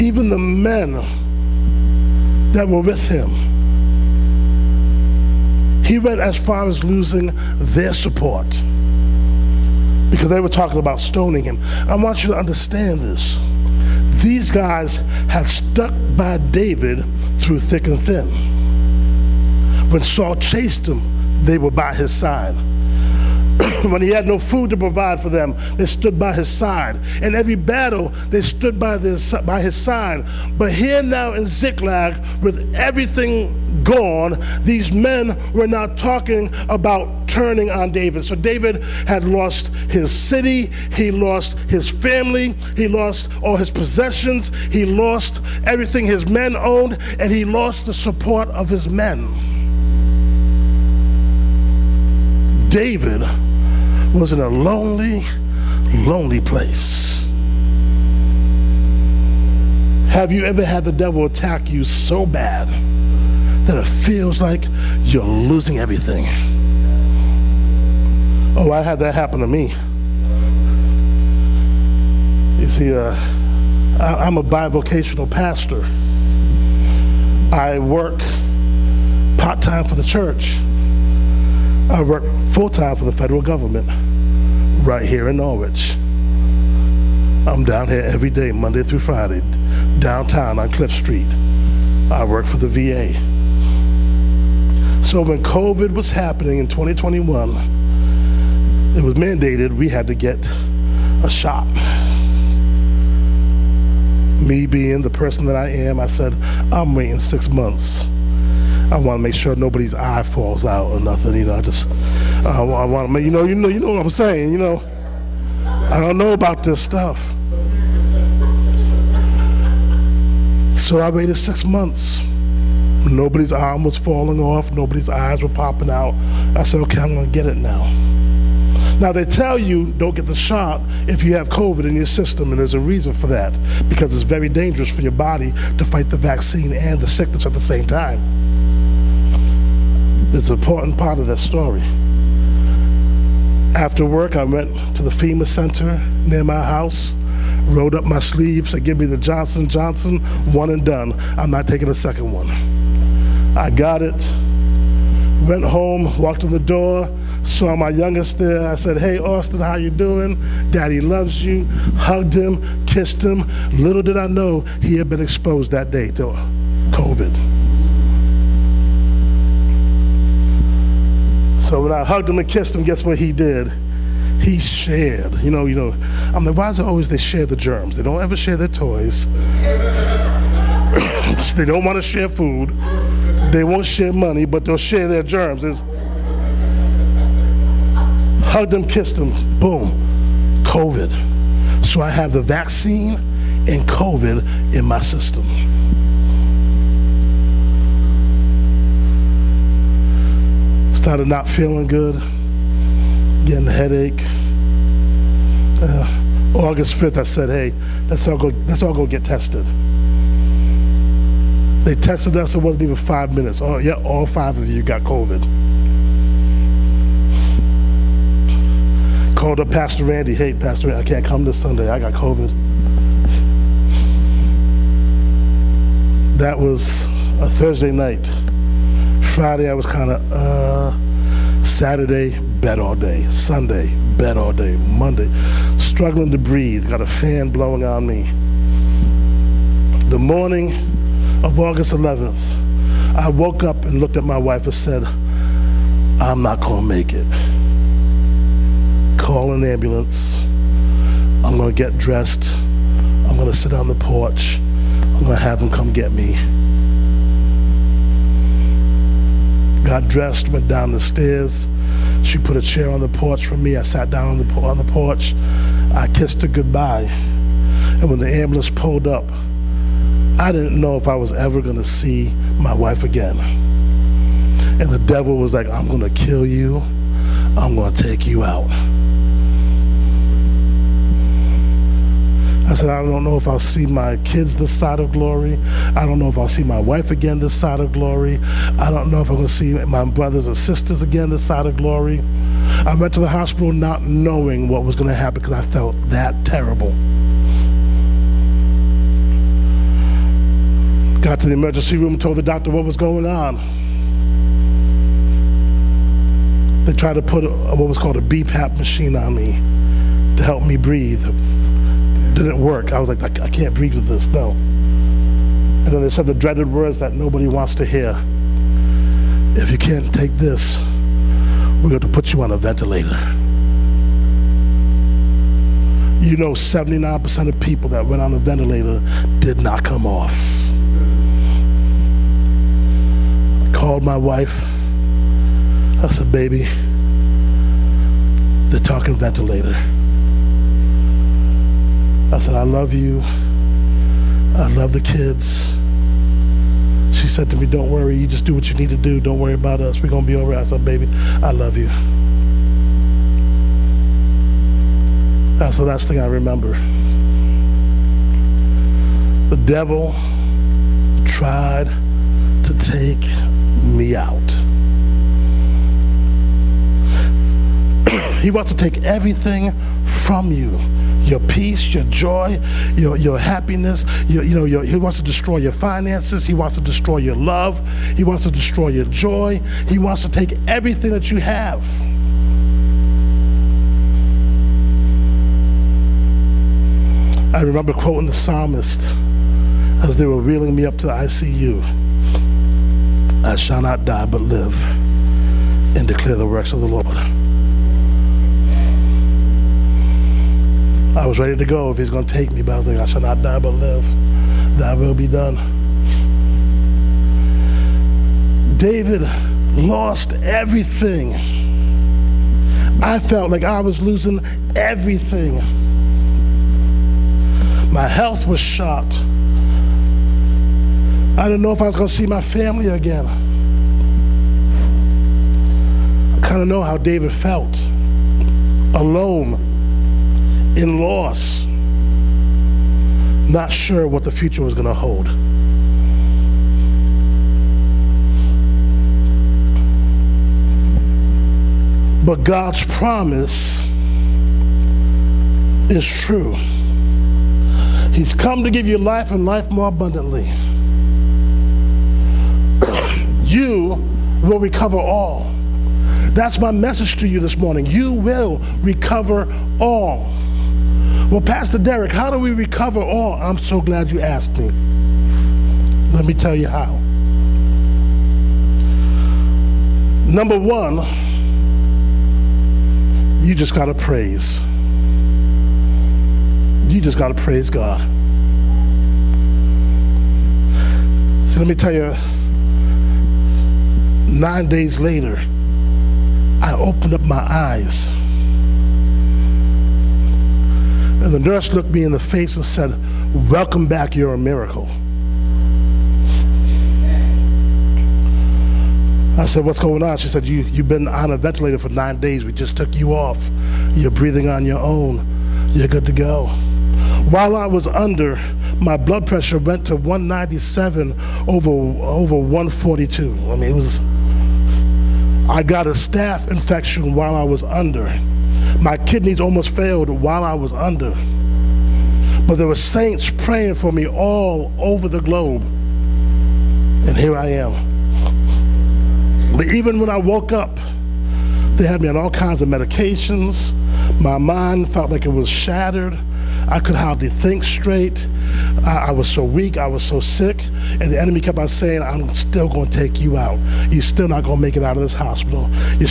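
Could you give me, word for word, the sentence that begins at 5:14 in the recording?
And then they said the dreaded words that nobody wants to hear.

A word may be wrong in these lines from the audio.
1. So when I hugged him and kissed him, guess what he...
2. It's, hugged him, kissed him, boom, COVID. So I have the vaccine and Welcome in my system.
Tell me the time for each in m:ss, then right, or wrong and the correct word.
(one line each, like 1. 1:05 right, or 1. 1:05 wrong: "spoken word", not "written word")
1. 2:51 right
2. 3:05 wrong: "COVID", not "Welcome".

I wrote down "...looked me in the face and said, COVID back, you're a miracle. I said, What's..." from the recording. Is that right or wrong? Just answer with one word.
wrong.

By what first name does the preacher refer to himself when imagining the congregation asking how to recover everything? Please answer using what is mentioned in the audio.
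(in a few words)
Derek.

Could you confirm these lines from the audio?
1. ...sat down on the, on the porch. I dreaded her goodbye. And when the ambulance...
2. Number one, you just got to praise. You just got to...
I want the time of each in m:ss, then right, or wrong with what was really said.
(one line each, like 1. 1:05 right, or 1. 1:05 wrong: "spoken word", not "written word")
1. 4:23 wrong: "kissed", not "dreaded"
2. 7:50 right.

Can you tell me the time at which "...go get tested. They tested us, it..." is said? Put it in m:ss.
3:28.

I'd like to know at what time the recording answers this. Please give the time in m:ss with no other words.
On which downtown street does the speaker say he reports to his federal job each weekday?
1:30.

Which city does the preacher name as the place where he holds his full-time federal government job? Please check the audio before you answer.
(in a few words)
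Norwich.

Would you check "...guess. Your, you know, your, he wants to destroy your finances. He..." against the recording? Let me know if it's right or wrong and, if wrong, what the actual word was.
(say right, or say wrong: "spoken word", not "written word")
wrong: "happiness", not "guess".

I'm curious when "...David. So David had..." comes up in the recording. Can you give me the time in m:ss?
0:37.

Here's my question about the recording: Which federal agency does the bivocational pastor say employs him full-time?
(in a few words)
VA.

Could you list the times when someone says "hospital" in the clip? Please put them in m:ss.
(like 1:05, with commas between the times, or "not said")
4:53, 9:05.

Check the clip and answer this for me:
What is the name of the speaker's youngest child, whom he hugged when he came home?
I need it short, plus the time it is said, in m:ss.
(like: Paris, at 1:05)
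Austin, at 2:39.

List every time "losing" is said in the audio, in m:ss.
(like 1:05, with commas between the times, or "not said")
0:06, 1:05, 6:54.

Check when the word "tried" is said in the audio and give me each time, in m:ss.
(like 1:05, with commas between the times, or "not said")
5:06, 6:01.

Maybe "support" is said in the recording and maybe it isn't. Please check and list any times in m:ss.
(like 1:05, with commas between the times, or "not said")
0:07, 0:47.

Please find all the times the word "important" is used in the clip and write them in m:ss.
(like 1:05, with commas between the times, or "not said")
2:20.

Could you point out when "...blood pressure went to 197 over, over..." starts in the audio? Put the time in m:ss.
8:28.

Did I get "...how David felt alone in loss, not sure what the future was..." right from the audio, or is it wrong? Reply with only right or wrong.
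right.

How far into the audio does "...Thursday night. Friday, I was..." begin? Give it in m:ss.
3:47.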